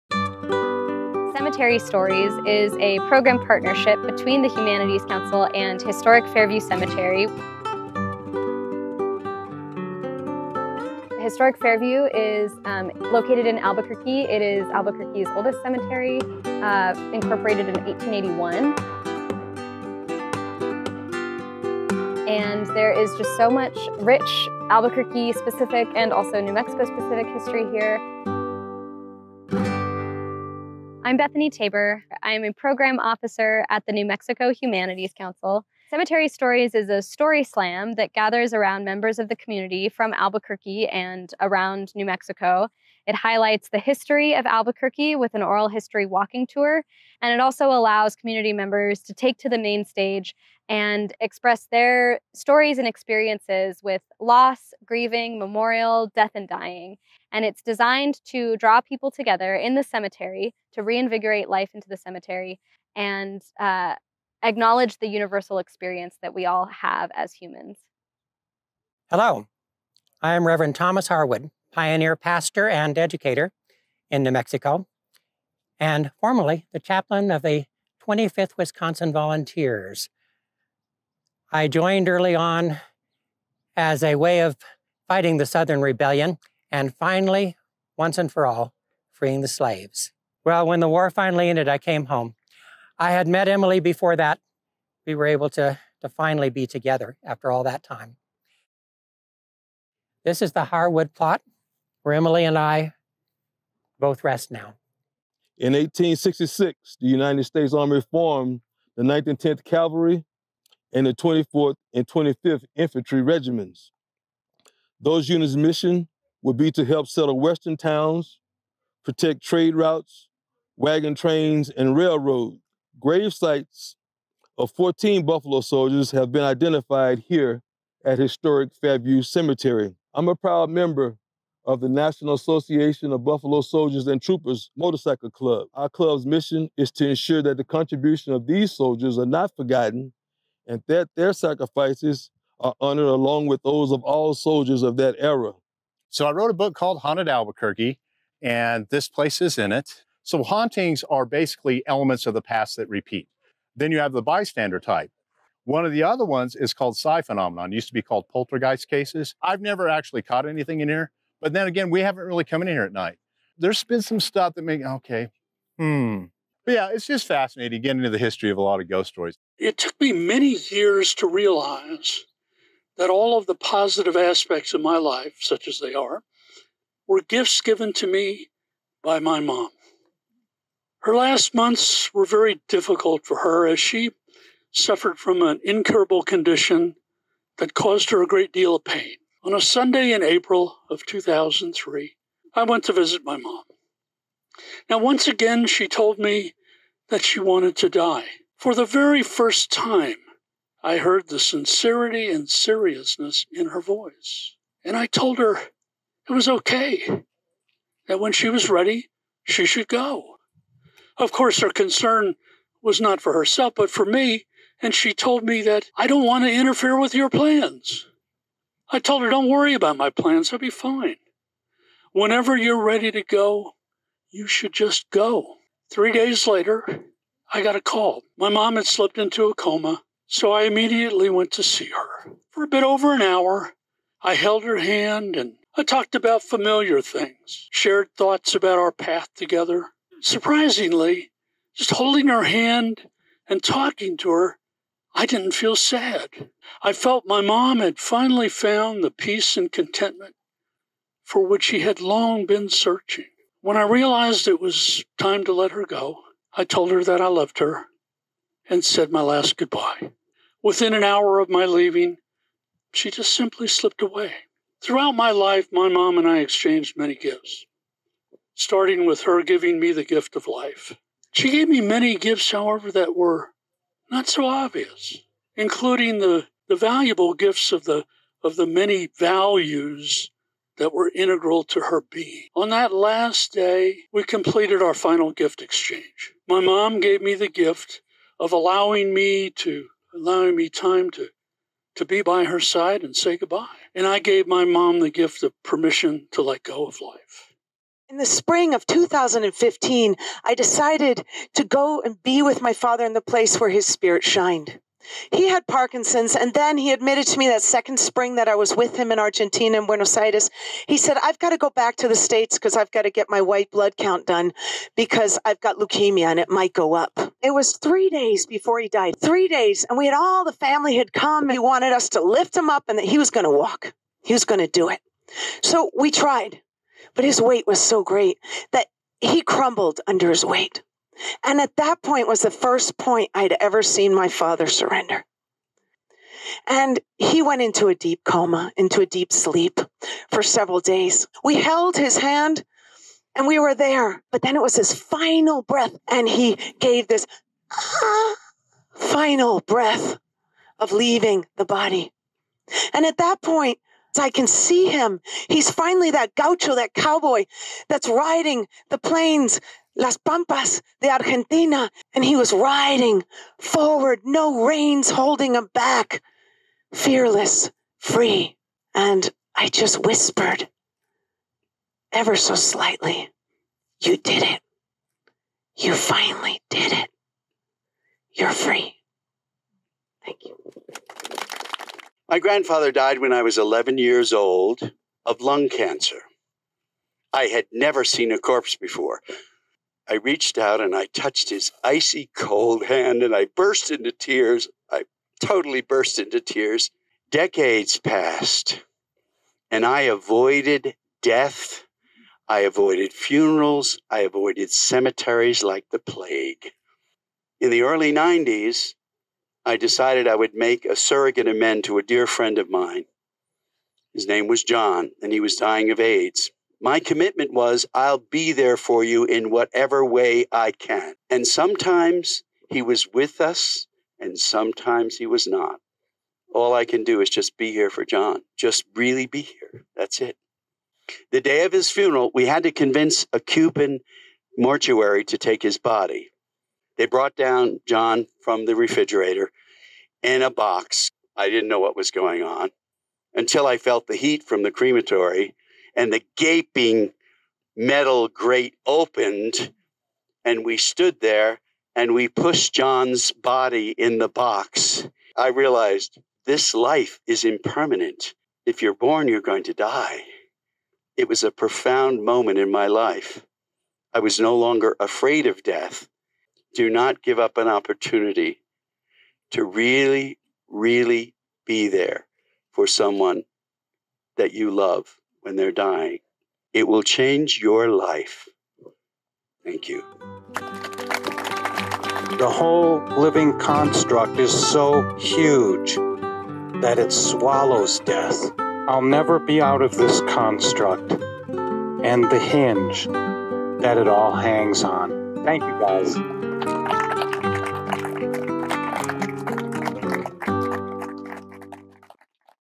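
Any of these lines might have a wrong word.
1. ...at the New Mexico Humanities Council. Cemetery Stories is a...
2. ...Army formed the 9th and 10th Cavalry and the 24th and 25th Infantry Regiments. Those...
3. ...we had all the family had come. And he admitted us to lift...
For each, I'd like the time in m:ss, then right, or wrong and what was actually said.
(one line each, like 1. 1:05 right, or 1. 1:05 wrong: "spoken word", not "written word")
1. 0:33 right
2. 1:47 right
3. 5:19 wrong: "wanted", not "admitted".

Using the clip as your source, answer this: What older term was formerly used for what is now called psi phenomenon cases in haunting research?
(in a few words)
poltergeist.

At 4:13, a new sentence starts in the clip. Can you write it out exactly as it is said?
When I realized it was time to let her go, I told her that I loved her and said my last goodbye.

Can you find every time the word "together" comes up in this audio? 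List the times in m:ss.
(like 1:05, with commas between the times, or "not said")
0:59, 1:36, 3:59.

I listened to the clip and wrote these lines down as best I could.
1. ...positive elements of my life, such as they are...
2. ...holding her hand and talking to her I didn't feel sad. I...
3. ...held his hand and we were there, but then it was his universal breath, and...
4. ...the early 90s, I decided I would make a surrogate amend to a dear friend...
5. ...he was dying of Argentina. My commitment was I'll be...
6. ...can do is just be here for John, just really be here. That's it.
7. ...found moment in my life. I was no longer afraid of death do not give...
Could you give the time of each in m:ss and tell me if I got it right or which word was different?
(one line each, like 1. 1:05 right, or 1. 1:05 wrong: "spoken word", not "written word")
1. 2:53 wrong: "aspects", not "elements"
2. 4:01 right
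3. 5:41 wrong: "final", not "universal"
4. 6:47 right
5. 6:55 wrong: "AIDS", not "Argentina"
6. 7:06 right
7. 7:41 wrong: "profound", not "found".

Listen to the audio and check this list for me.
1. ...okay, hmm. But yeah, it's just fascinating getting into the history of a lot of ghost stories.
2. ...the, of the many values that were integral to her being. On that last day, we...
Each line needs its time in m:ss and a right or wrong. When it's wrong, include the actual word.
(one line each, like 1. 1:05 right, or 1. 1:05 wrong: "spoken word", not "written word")
1. 2:44 right
2. 4:37 right.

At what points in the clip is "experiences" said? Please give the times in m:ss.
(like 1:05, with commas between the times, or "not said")
0:52, 1:05.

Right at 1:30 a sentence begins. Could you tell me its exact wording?
Well, when the war finally ended, I came home.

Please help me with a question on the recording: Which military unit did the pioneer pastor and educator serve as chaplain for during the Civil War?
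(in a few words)
25th Wisconsin Volunteers.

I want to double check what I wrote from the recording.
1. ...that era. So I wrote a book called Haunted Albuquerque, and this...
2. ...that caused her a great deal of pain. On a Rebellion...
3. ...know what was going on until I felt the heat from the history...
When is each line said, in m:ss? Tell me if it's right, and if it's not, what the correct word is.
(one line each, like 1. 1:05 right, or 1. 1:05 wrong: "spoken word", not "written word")
1. 2:24 right
2. 3:07 wrong: "Sunday", not "Rebellion"
3. 7:21 wrong: "crematory", not "history".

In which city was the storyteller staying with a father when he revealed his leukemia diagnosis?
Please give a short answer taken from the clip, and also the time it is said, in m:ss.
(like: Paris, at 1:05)
Buenos Aires, at 5:09.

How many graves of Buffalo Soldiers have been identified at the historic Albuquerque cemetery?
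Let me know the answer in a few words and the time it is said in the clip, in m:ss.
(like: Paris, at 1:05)
14, at 2:04.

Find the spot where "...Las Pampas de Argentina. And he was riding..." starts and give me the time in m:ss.
5:59.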